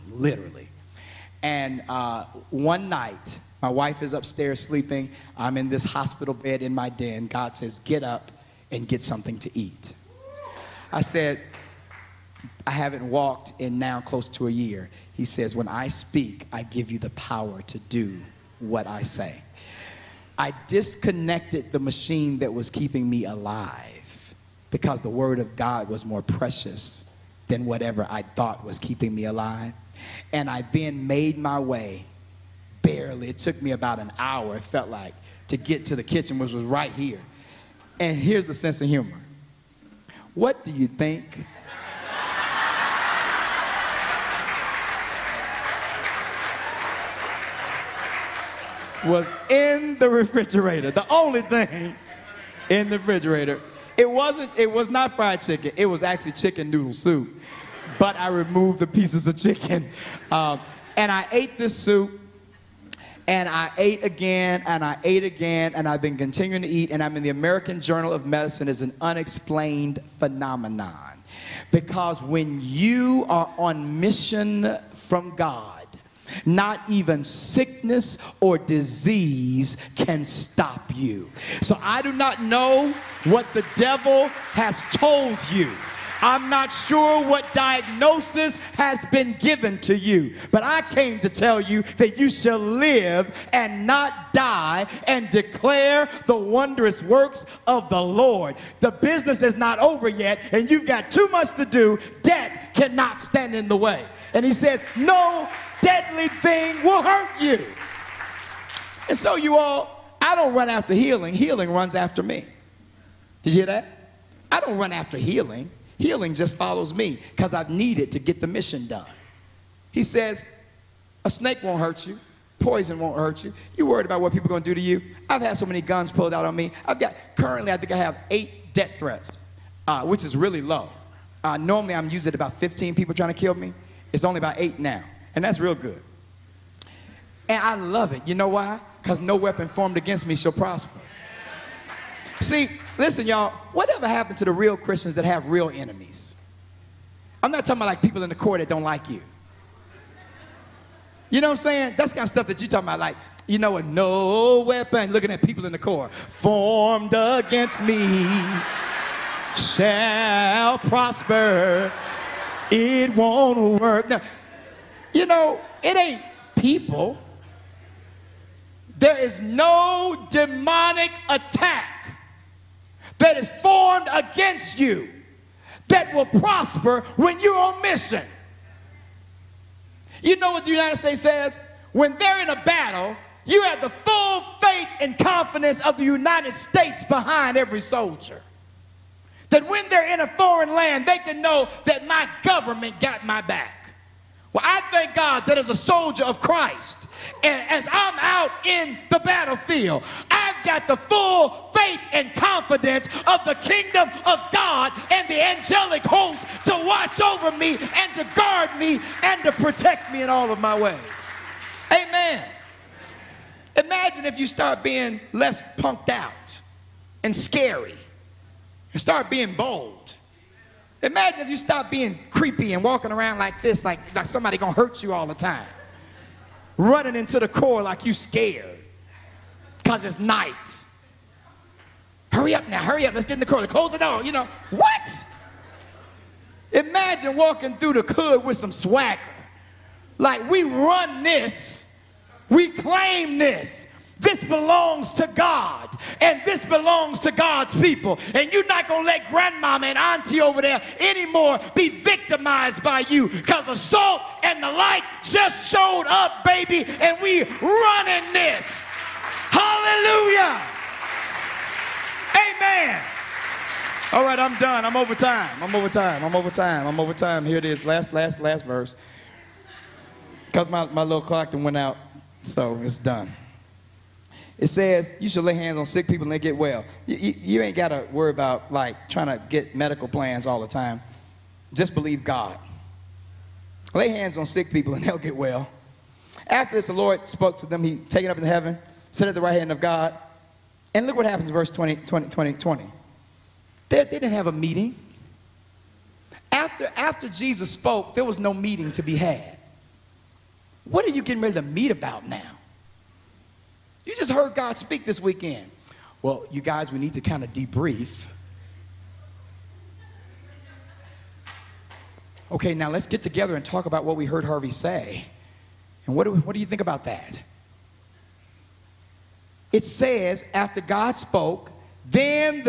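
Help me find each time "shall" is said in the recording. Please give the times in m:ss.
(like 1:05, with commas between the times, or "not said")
1:32, 2:20, 2:39.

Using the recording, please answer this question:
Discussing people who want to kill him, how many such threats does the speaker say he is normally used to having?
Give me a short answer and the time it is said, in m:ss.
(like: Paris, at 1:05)
15, at 2:12.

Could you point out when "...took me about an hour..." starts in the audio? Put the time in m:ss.
0:33.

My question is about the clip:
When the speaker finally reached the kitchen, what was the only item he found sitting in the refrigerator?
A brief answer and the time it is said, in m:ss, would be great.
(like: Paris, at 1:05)
chicken noodle soup, at 0:56.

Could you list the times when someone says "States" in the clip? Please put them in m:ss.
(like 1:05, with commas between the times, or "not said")
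3:00, 3:06.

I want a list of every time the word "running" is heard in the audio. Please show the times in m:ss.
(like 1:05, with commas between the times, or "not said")
3:46, 4:17.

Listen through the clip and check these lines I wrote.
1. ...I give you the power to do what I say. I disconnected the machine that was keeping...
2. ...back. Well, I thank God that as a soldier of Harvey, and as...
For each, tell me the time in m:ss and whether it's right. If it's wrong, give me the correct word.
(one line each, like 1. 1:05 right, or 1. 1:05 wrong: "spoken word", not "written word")
1. 0:16 right
2. 3:13 wrong: "Christ", not "Harvey".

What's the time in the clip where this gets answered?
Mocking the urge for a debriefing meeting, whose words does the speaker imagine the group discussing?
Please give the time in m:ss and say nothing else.
5:14.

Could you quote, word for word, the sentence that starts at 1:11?
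Because when you are on mission from God, not even sickness or disease can stop you.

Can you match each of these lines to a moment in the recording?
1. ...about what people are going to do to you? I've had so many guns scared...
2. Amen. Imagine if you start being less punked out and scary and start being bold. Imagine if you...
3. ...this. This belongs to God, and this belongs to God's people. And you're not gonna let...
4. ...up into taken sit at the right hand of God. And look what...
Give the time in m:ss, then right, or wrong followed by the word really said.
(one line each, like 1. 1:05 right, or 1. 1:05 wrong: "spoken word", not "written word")
1. 2:04 wrong: "pulled", not "scared"
2. 3:31 right
3. 4:03 right
4. 4:48 wrong: "heaven", not "taken".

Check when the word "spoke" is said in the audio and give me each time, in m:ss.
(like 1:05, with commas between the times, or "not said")
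4:47, 4:57, 5:21.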